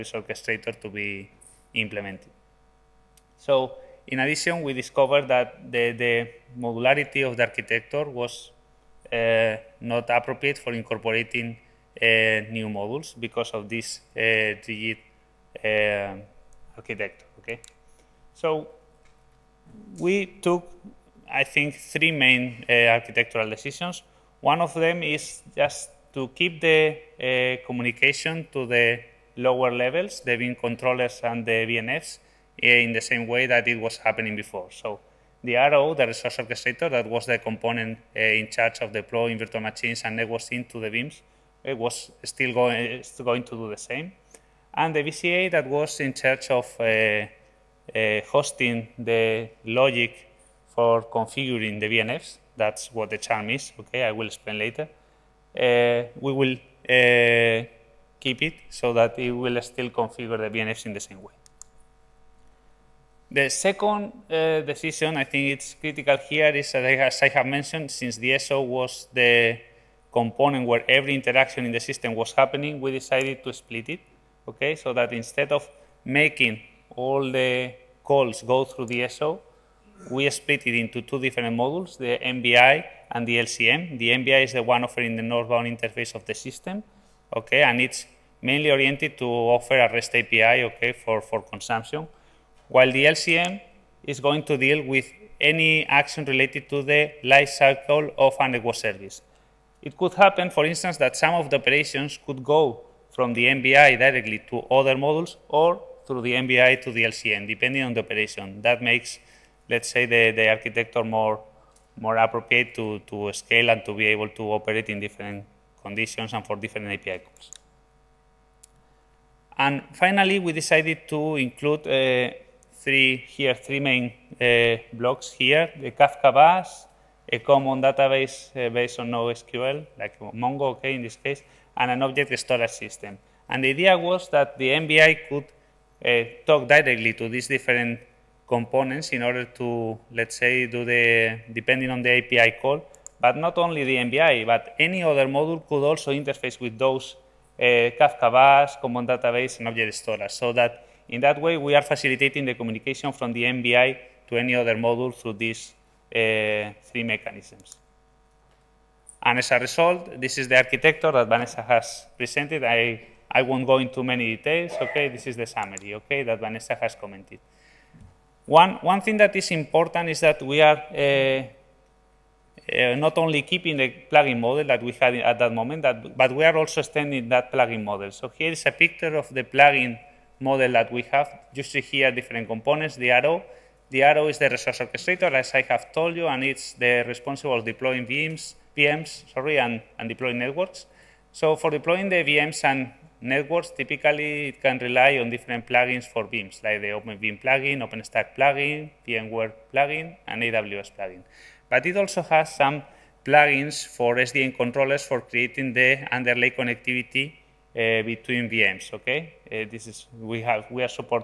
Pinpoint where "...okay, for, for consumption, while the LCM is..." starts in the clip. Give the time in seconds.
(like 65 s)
90 s.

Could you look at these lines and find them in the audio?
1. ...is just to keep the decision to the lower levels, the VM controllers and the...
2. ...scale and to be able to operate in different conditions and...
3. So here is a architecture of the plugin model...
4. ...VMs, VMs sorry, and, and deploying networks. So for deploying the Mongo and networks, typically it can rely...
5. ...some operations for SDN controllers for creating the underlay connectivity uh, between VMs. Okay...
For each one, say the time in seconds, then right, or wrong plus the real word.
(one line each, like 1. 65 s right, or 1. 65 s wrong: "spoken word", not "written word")
1. 25 s wrong: "communication", not "decision"
2. 113 s right
3. 178 s wrong: "picture", not "architecture"
4. 188 s wrong: "VMs", not "Mongo"
5. 202 s wrong: "plugins", not "operations".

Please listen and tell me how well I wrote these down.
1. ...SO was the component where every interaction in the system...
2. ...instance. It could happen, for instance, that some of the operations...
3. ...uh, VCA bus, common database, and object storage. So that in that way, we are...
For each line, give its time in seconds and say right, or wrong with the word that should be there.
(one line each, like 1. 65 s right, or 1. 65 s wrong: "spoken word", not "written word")
1. 68 s right
2. 98 s wrong: "service", not "instance"
3. 147 s wrong: "Kafka", not "VCA".